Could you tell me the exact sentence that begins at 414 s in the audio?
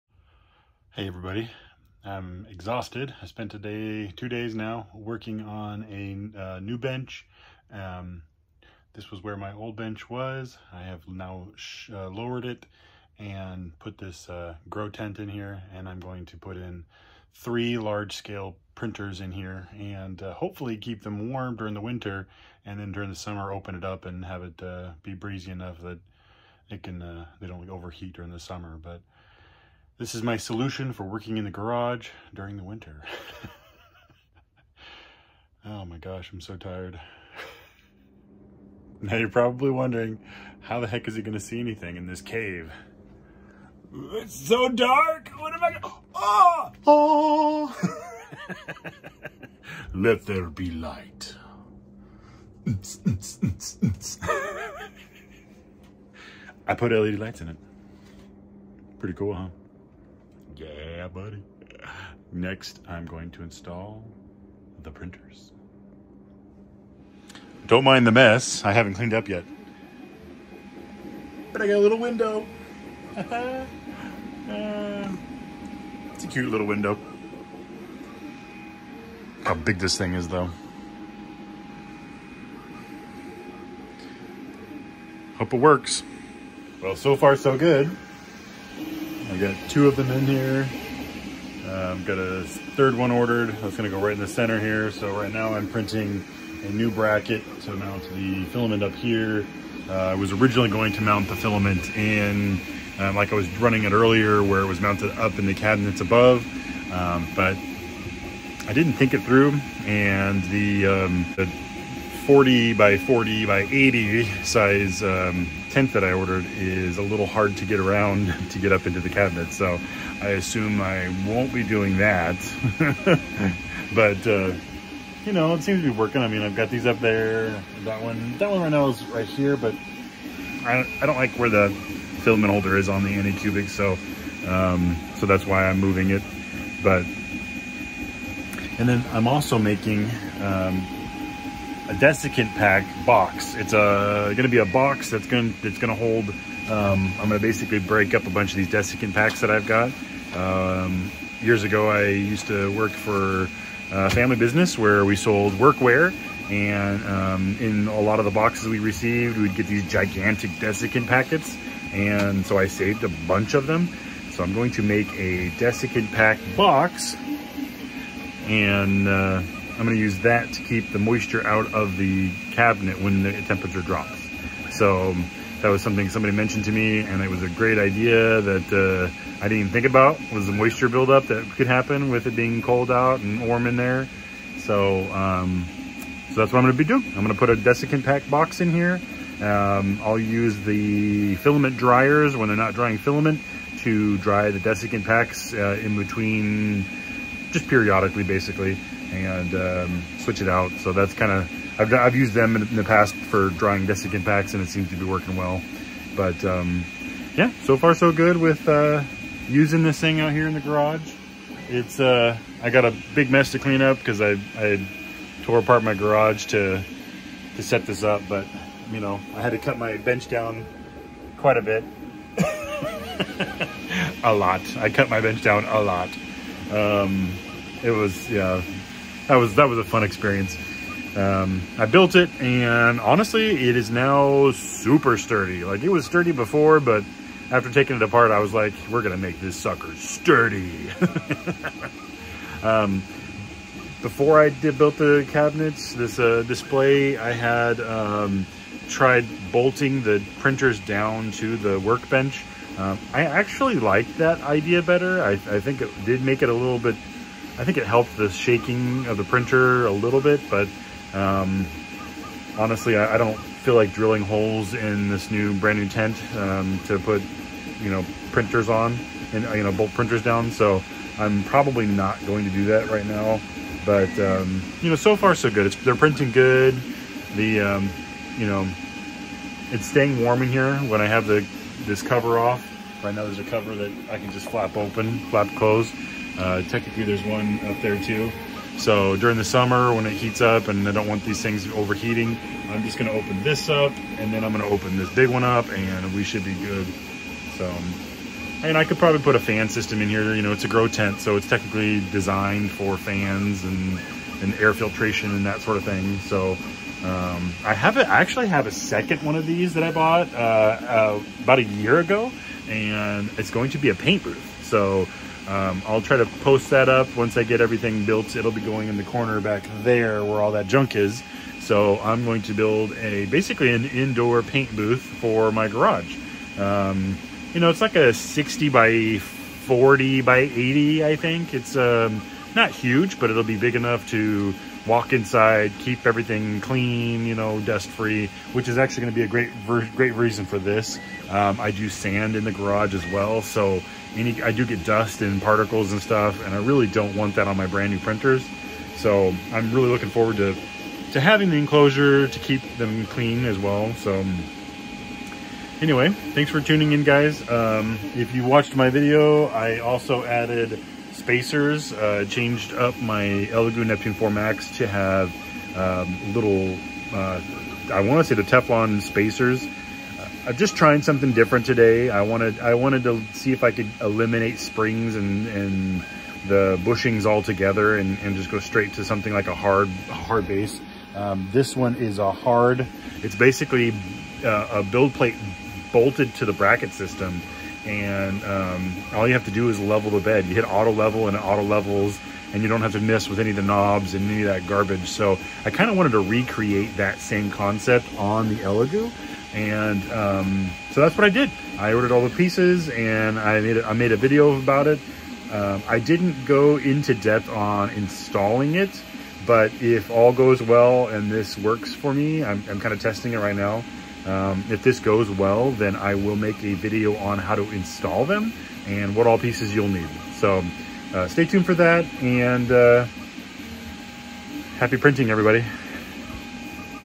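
Um, if this goes well, then I will make a video on how to install them and what all pieces you'll need.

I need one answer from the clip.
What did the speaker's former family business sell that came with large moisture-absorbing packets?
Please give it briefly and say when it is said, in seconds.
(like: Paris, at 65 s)
workwear, at 155 s.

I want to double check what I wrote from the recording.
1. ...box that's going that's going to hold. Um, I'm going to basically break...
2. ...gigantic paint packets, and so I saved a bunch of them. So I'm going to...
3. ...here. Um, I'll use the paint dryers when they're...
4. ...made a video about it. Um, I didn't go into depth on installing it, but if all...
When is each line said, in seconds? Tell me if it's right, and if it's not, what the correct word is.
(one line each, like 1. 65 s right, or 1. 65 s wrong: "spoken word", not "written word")
1. 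144 s right
2. 159 s wrong: "desiccant", not "paint"
3. 188 s wrong: "filament", not "paint"
4. 403 s right.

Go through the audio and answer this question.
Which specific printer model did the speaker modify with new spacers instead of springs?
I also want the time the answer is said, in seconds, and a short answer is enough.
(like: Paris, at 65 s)
Elegoo Neptune 4 Max, at 363 s.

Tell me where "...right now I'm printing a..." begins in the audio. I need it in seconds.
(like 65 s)
95 s.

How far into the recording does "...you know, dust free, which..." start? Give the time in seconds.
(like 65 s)
337 s.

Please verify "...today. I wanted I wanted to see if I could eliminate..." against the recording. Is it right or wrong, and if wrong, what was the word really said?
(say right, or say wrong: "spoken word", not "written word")
right.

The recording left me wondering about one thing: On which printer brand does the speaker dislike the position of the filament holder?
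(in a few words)
Anycubic.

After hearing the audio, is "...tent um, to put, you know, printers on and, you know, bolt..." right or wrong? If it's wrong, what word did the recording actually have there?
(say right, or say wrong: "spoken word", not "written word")
right.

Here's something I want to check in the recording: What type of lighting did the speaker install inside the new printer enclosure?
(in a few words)
LED lights.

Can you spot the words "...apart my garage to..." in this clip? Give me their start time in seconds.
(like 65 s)
215 s.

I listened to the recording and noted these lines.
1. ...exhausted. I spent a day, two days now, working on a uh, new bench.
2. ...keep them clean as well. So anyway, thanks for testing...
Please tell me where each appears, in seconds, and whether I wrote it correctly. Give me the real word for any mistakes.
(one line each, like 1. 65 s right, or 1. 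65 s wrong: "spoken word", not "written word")
1. 2 s right
2. 352 s wrong: "tuning", not "testing".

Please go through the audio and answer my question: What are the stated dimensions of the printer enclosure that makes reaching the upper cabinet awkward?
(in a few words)
40 by 40 by 80.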